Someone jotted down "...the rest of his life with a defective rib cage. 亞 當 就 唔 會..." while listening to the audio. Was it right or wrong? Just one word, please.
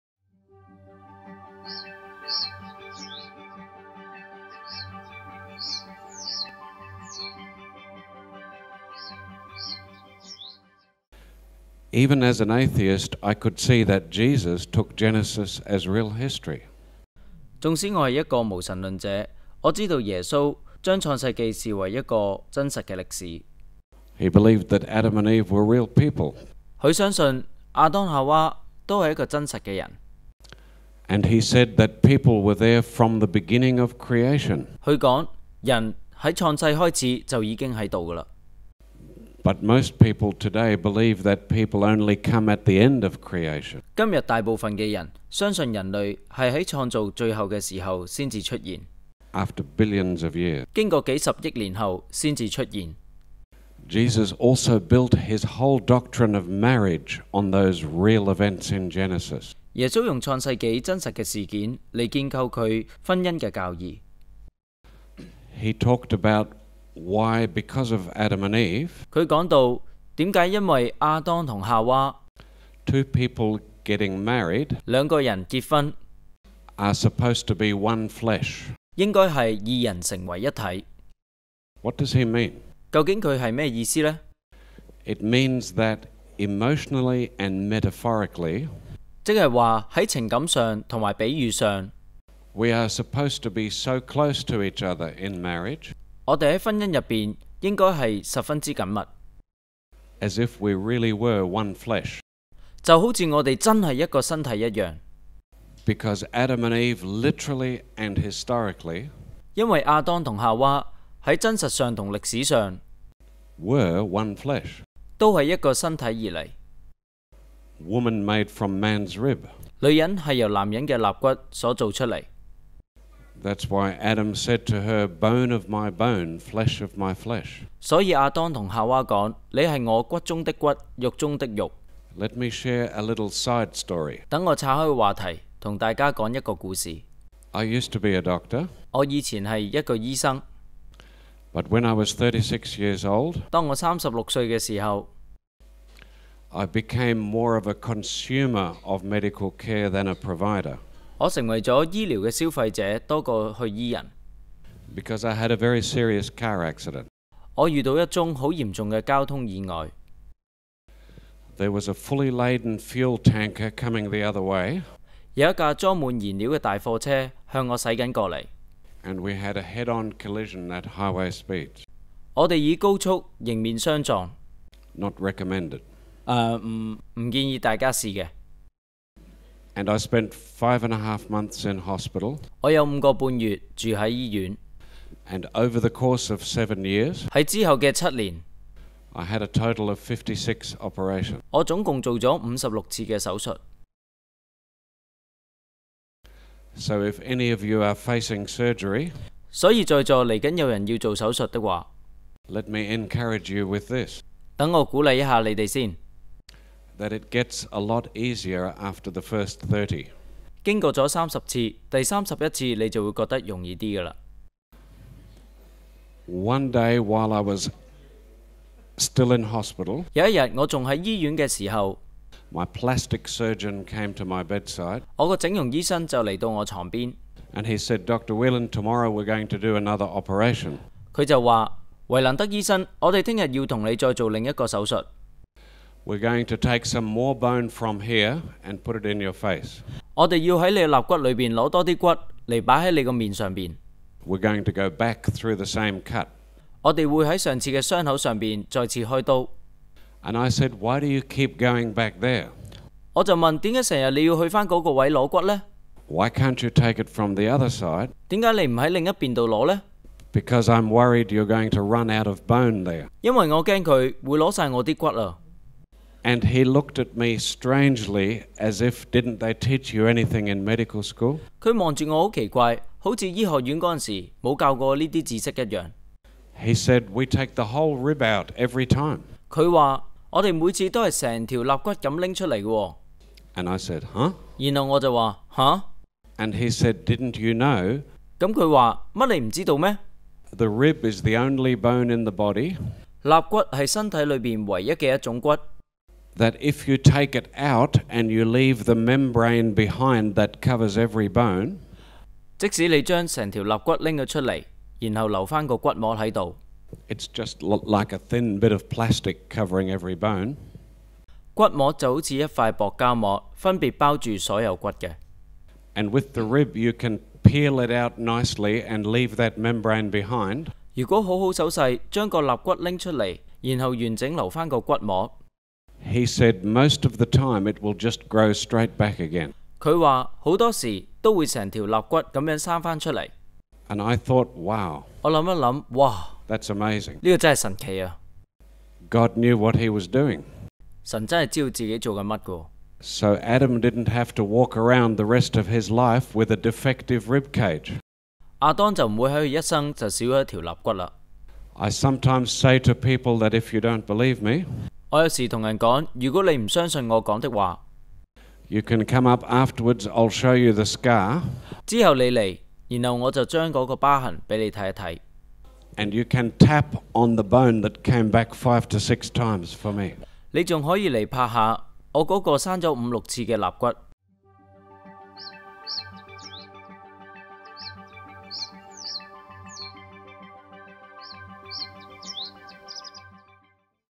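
right.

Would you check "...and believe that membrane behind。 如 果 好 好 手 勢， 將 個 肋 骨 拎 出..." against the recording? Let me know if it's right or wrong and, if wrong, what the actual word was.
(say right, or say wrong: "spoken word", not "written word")
wrong: "leave", not "believe".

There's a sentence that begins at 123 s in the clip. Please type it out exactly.
That's why Adam said to her, "Bone of my bone, flesh of my flesh." Let me share a little side story.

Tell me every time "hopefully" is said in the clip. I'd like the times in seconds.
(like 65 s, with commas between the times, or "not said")
not said.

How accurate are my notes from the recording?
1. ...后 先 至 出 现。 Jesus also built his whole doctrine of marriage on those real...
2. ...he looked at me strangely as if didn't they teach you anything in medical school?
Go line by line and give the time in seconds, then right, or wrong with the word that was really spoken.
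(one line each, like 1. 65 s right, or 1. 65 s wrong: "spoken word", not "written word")
1. 51 s right
2. 266 s right.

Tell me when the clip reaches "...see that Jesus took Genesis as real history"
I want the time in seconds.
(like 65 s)
13 s.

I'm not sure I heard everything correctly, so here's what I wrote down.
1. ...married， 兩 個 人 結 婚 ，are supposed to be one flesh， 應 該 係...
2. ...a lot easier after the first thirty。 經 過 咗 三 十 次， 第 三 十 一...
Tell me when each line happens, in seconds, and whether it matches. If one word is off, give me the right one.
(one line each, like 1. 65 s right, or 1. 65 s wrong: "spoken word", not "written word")
1. 74 s right
2. 207 s right.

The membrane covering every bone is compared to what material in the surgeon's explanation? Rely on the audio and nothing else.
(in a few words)
thin bit of plastic.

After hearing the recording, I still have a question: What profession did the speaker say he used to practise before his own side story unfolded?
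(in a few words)
a doctor.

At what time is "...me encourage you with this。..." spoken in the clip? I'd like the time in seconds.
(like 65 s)
202 s.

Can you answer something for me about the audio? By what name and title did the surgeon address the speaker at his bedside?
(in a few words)
Doctor Whelan.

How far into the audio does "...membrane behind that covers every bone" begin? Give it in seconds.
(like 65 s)
298 s.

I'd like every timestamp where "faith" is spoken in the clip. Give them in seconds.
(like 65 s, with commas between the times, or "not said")
not said.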